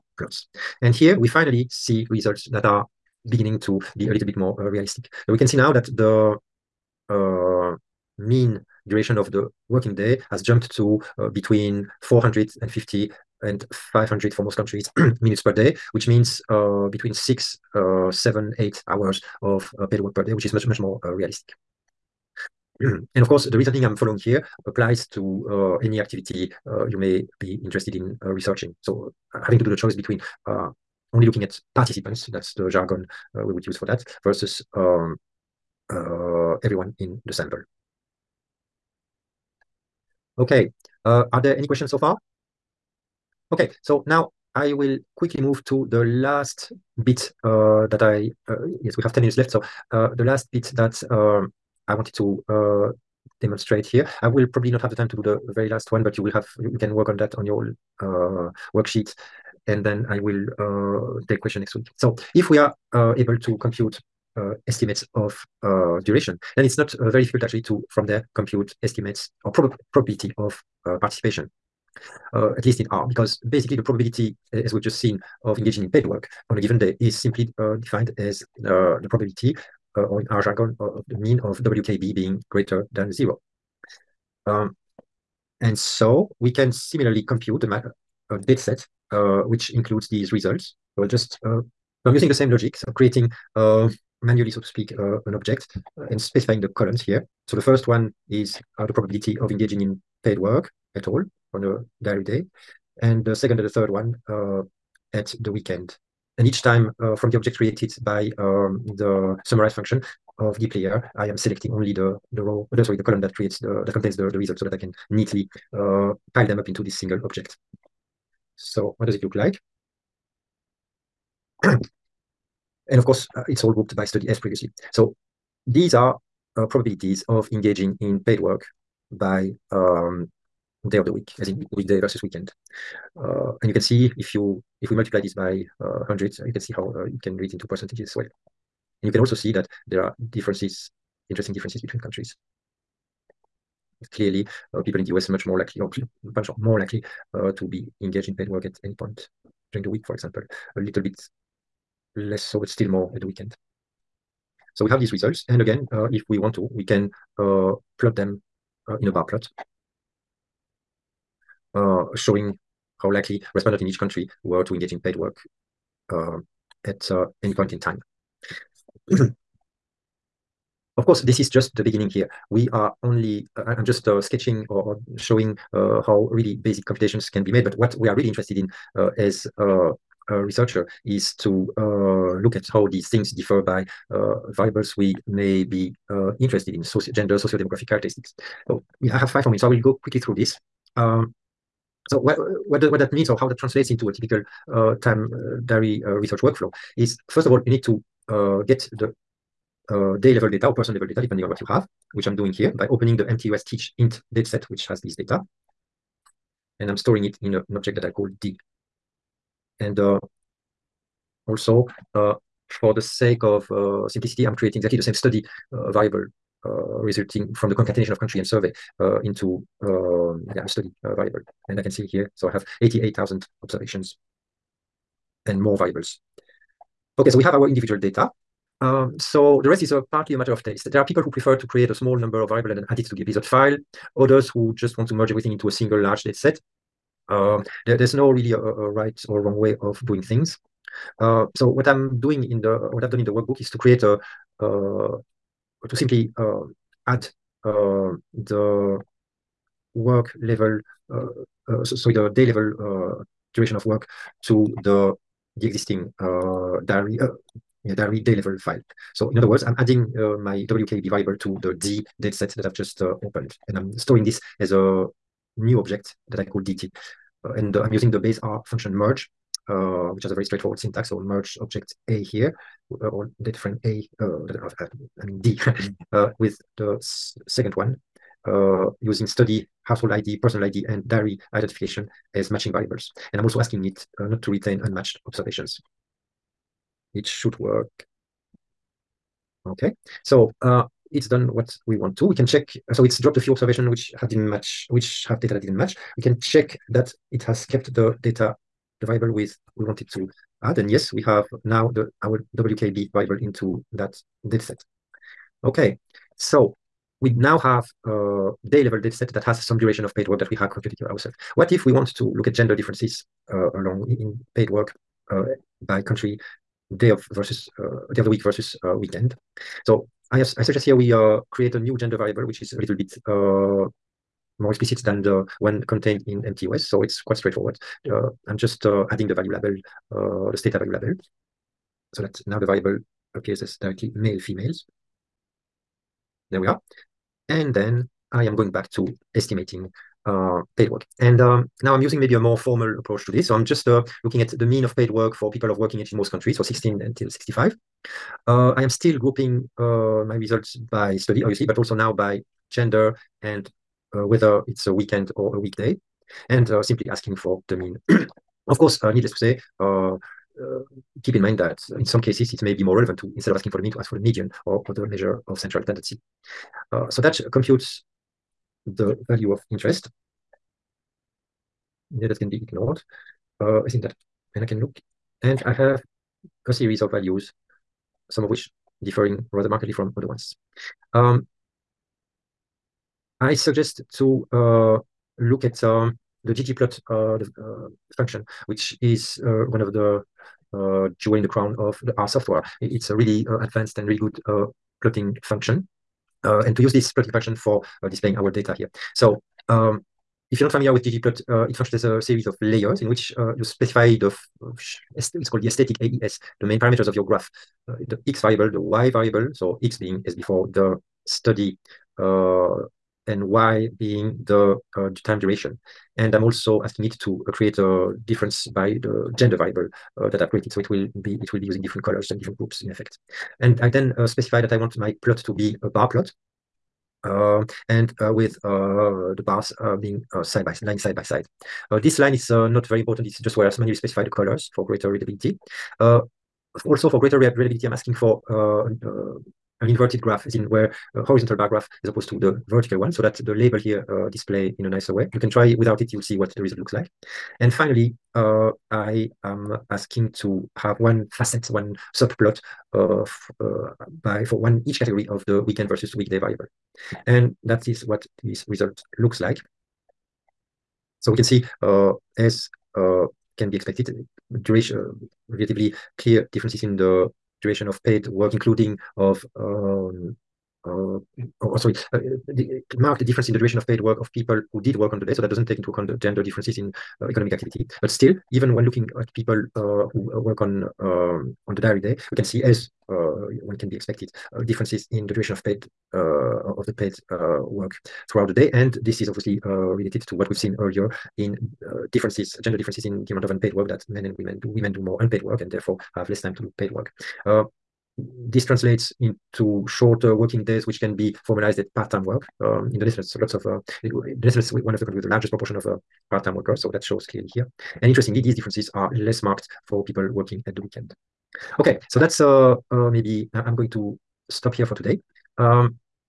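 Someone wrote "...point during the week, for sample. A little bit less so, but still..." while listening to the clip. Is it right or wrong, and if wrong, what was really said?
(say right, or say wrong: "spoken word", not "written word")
wrong: "example", not "sample".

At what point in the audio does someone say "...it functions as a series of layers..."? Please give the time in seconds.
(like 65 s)
401 s.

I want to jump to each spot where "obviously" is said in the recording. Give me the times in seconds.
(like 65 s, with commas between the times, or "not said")
351 s, 489 s.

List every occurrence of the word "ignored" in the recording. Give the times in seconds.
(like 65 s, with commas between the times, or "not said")
372 s.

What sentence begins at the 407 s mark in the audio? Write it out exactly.
Uh, the x variable, the y variable, so x being as before the study uh, and y being the uh, time duration.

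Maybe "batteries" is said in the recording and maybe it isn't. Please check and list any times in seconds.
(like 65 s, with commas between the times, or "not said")
not said.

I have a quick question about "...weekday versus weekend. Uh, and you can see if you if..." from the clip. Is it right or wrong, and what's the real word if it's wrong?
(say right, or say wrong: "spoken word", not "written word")
right.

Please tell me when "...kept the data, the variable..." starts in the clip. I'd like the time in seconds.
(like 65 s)
297 s.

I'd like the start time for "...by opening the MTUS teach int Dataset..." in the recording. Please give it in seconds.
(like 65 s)
202 s.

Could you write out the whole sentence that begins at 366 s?
Uh, so that computes the value of interest.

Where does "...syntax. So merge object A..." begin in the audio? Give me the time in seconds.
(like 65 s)
270 s.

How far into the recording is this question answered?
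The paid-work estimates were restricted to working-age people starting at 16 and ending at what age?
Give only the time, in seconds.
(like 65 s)
346 s.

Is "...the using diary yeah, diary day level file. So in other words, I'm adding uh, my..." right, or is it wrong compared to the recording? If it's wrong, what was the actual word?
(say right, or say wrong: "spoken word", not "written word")
wrong: "existing", not "using".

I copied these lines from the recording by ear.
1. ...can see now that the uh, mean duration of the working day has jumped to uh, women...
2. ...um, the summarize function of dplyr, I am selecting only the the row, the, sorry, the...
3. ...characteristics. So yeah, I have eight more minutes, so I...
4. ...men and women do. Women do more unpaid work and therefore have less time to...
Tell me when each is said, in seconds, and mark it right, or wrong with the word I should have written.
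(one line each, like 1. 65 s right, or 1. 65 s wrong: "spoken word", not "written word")
1. 5 s wrong: "between", not "women"
2. 108 s right
3. 187 s wrong: "five", not "eight"
4. 494 s right.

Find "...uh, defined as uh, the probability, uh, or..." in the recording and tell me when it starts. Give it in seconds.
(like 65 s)
77 s.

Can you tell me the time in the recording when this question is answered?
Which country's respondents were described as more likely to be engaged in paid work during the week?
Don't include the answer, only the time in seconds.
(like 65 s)
144 s.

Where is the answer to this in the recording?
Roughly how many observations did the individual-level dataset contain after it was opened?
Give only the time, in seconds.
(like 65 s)
222 s.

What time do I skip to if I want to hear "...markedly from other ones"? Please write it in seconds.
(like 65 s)
379 s.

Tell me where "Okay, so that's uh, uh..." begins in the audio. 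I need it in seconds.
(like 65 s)
511 s.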